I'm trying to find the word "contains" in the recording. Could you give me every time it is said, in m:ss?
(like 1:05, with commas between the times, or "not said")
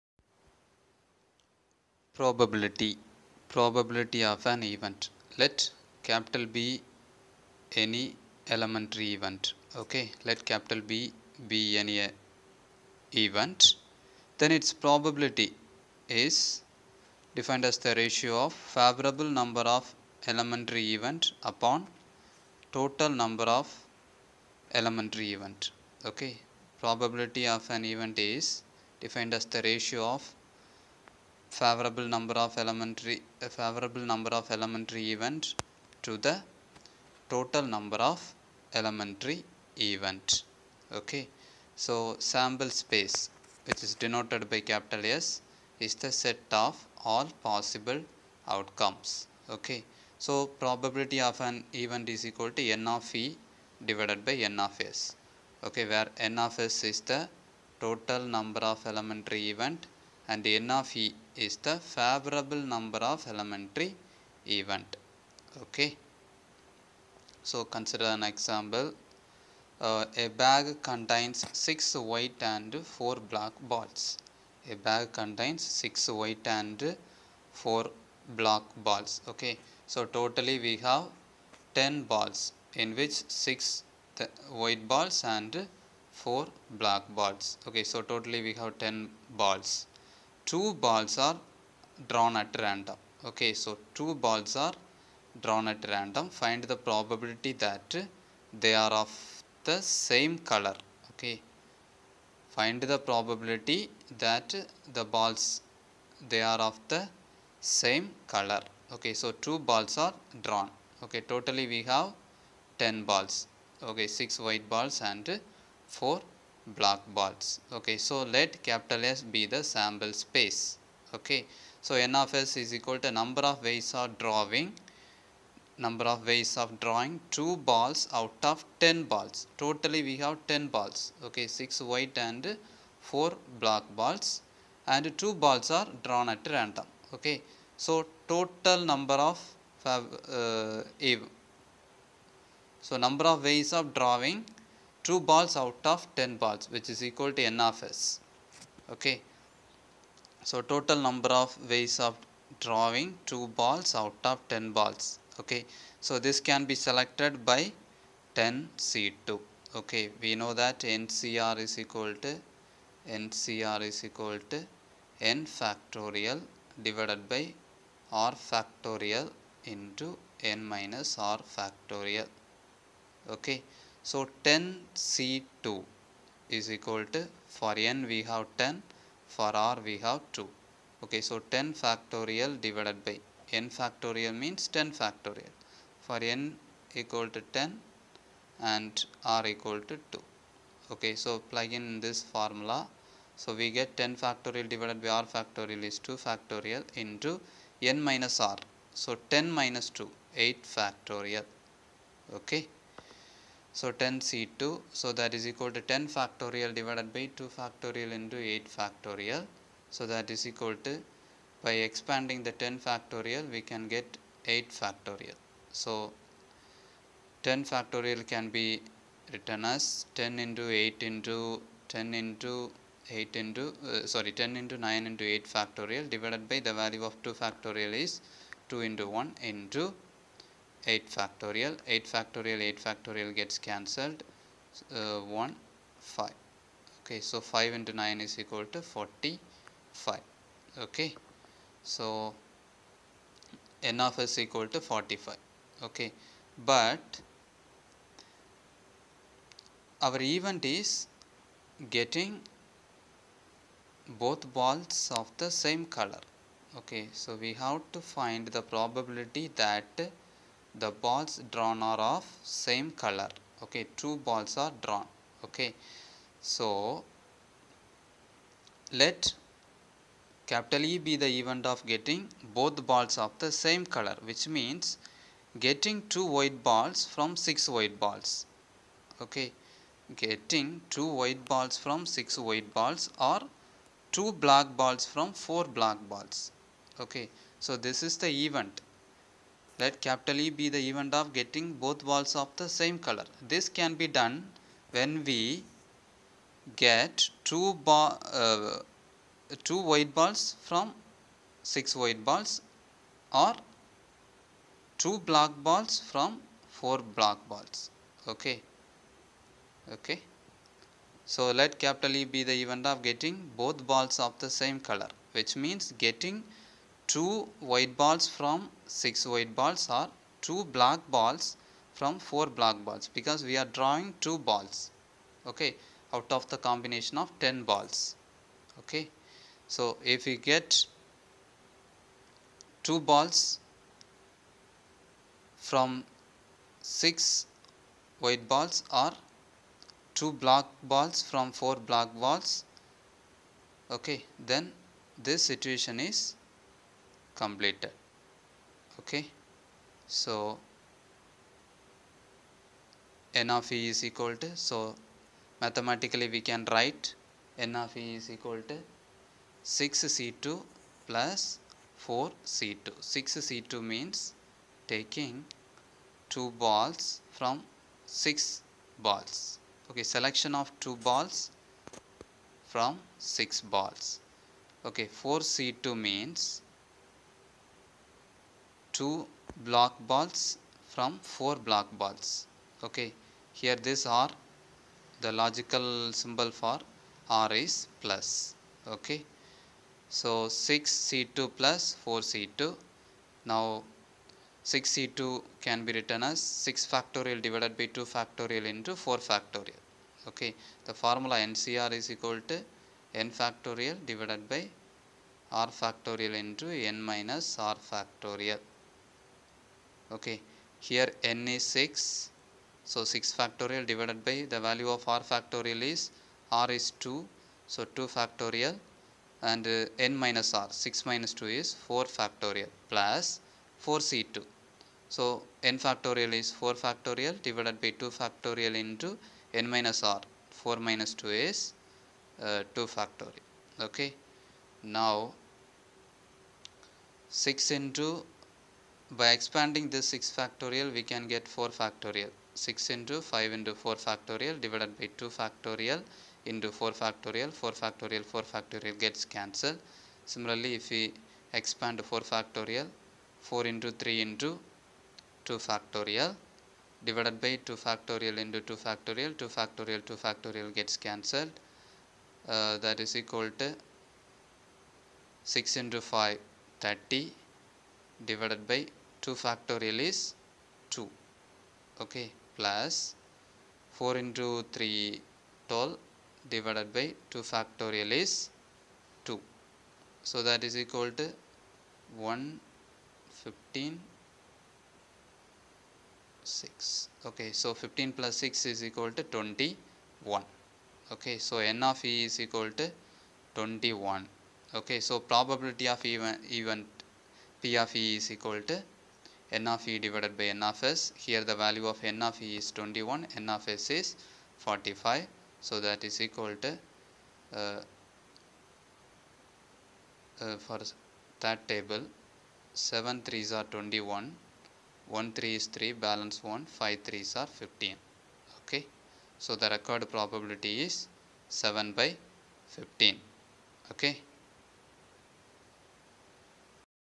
1:10, 1:15.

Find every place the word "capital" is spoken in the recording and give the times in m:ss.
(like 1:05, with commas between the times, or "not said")
0:06, 0:10, 0:44, 1:58, 4:30, 4:49, 5:11.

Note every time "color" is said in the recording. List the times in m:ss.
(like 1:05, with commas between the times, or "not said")
1:40, 1:48, 4:15, 4:22, 4:33, 4:53, 5:14.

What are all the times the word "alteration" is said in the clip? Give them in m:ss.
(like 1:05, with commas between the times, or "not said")
not said.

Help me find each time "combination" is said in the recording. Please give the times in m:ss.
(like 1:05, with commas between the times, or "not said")
5:26.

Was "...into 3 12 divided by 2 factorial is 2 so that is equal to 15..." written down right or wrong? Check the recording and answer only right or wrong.
right.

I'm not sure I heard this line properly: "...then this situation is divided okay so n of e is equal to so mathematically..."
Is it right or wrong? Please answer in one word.
wrong.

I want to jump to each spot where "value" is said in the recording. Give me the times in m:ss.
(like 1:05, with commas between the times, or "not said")
3:46, 6:54, 8:21.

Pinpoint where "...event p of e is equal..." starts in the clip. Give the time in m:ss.
8:16.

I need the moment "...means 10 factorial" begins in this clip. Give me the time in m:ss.
3:04.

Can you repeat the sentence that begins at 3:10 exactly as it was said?
Okay, so plug in this formula.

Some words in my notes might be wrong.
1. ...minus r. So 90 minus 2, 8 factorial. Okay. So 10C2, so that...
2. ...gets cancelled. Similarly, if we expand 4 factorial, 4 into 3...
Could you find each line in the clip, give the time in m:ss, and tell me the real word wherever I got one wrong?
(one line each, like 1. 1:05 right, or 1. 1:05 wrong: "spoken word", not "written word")
1. 3:18 wrong: "10", not "90"
2. 7:28 right.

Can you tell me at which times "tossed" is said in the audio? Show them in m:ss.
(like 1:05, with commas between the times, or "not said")
not said.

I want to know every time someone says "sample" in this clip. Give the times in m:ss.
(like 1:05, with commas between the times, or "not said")
0:42, 1:59.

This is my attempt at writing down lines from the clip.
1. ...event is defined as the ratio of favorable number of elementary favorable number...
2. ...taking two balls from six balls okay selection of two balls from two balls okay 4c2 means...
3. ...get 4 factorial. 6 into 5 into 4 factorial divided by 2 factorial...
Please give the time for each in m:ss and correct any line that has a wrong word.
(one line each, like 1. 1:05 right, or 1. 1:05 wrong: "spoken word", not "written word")
1. 0:27 right
2. 6:04 wrong: "six", not "two"
3. 7:21 right.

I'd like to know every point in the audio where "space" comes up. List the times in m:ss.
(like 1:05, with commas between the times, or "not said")
0:42, 2:00.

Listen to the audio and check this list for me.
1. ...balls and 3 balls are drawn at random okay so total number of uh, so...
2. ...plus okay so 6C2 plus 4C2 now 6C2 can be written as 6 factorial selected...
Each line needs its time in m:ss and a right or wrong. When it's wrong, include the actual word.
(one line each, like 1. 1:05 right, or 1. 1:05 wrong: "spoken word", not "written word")
1. 2:13 wrong: "2", not "3"
2. 6:28 wrong: "divided", not "selected".